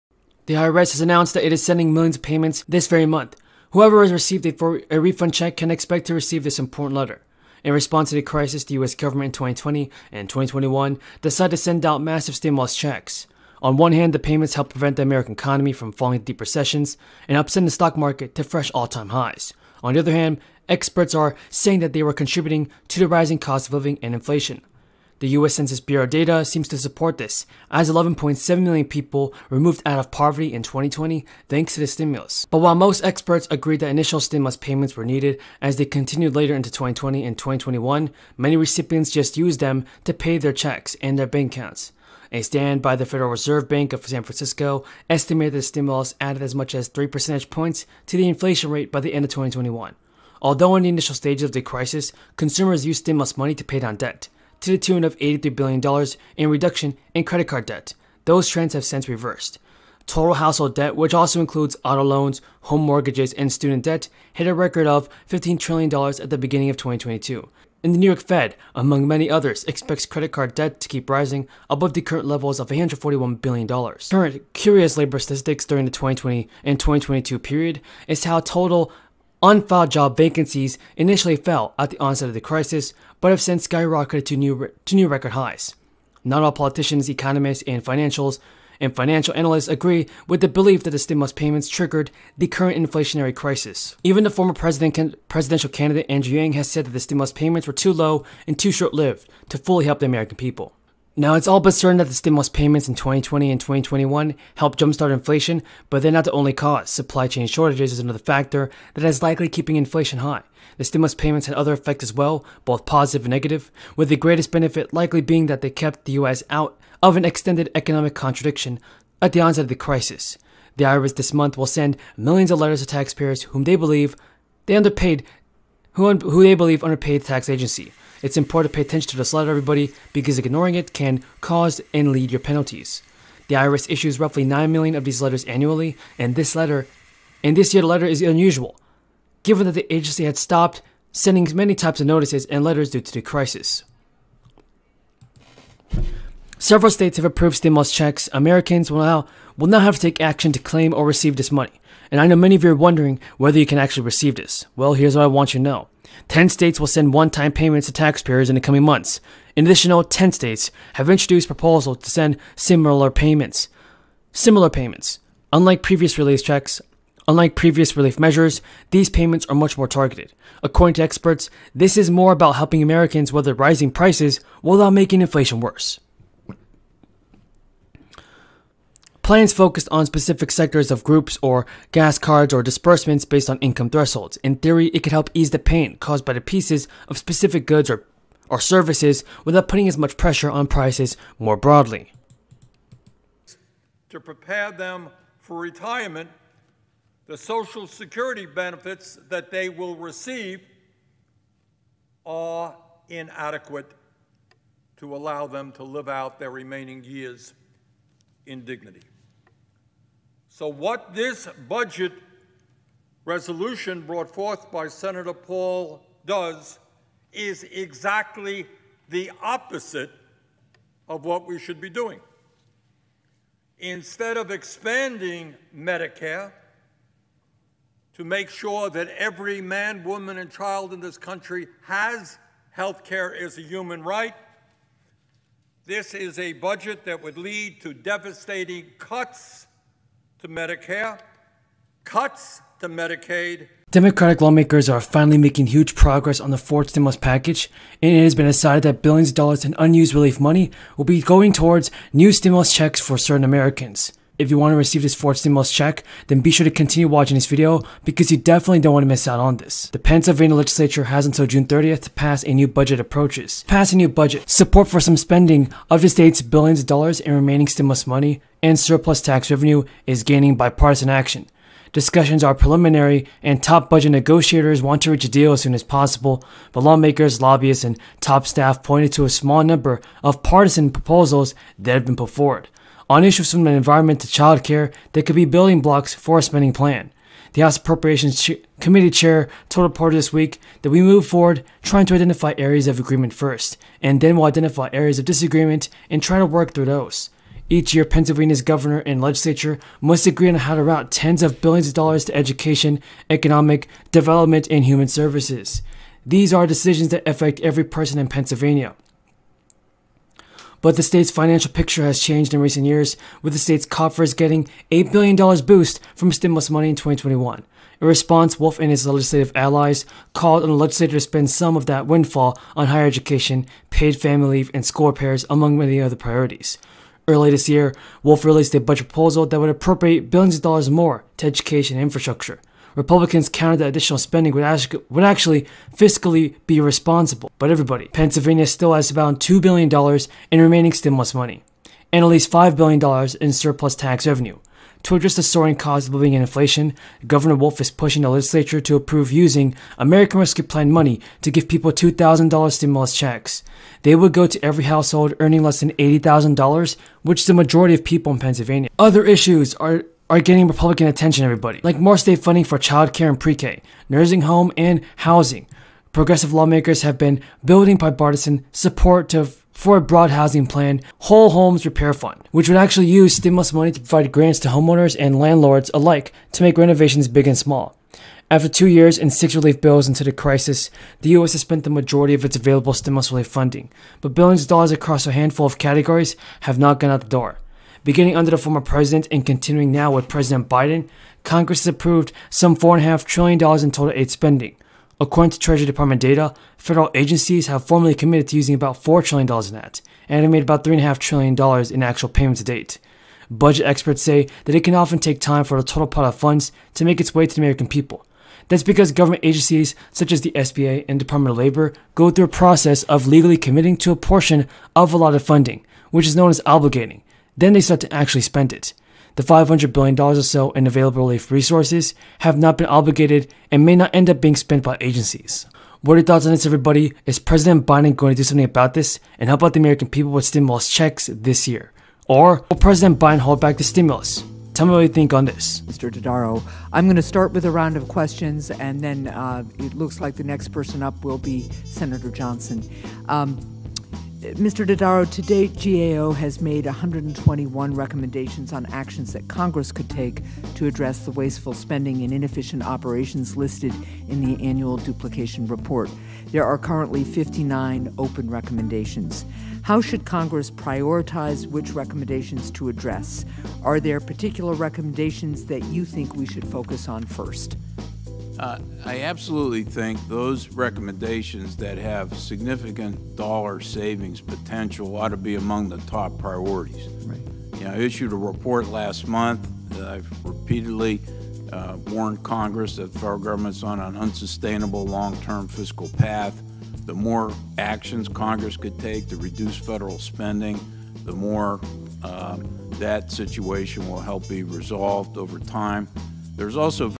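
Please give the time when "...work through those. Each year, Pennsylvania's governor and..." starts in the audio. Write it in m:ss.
4:56.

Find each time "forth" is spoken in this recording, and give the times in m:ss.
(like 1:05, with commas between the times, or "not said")
3:34.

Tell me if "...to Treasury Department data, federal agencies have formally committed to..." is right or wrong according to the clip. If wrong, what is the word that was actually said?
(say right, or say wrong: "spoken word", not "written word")
right.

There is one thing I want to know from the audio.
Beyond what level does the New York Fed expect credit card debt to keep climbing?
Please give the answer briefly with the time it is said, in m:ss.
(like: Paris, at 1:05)
$141 billion, at 1:12.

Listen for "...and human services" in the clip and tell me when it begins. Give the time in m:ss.
5:04.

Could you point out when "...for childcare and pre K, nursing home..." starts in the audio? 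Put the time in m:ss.
6:02.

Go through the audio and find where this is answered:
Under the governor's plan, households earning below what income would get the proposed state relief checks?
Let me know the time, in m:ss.
5:55.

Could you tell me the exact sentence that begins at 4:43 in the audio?
On issues from the environment to childcare, they could be building blocks for a spending plan.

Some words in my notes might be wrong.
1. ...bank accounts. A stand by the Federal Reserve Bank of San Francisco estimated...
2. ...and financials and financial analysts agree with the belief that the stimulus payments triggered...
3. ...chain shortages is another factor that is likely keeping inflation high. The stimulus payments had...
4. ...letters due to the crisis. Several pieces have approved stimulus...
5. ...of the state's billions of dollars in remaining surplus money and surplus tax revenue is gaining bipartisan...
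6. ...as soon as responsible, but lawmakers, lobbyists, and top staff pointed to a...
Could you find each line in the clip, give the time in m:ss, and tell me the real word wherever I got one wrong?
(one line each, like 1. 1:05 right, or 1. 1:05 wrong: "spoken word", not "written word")
1. 0:41 right
2. 1:27 right
3. 1:47 right
4. 2:22 wrong: "states", not "pieces"
5. 4:25 wrong: "stimulus", not "surplus"
6. 4:35 wrong: "possible", not "responsible".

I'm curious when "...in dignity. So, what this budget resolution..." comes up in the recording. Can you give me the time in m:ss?
3:28.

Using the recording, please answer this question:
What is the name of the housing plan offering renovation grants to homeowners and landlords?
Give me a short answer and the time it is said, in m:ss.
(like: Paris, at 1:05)
Whole Homes Repair Fund, at 6:11.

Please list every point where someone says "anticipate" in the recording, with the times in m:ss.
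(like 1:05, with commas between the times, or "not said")
not said.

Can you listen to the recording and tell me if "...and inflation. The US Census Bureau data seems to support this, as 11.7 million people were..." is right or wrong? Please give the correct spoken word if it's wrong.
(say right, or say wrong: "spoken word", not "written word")
right.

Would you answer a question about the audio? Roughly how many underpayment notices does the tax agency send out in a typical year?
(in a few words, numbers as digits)
9 million.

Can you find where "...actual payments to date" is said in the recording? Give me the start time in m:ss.
6:42.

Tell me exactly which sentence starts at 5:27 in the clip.
Early this year, Wolf released a budget proposal that would appropriate billions of dollars more to education and infrastructure.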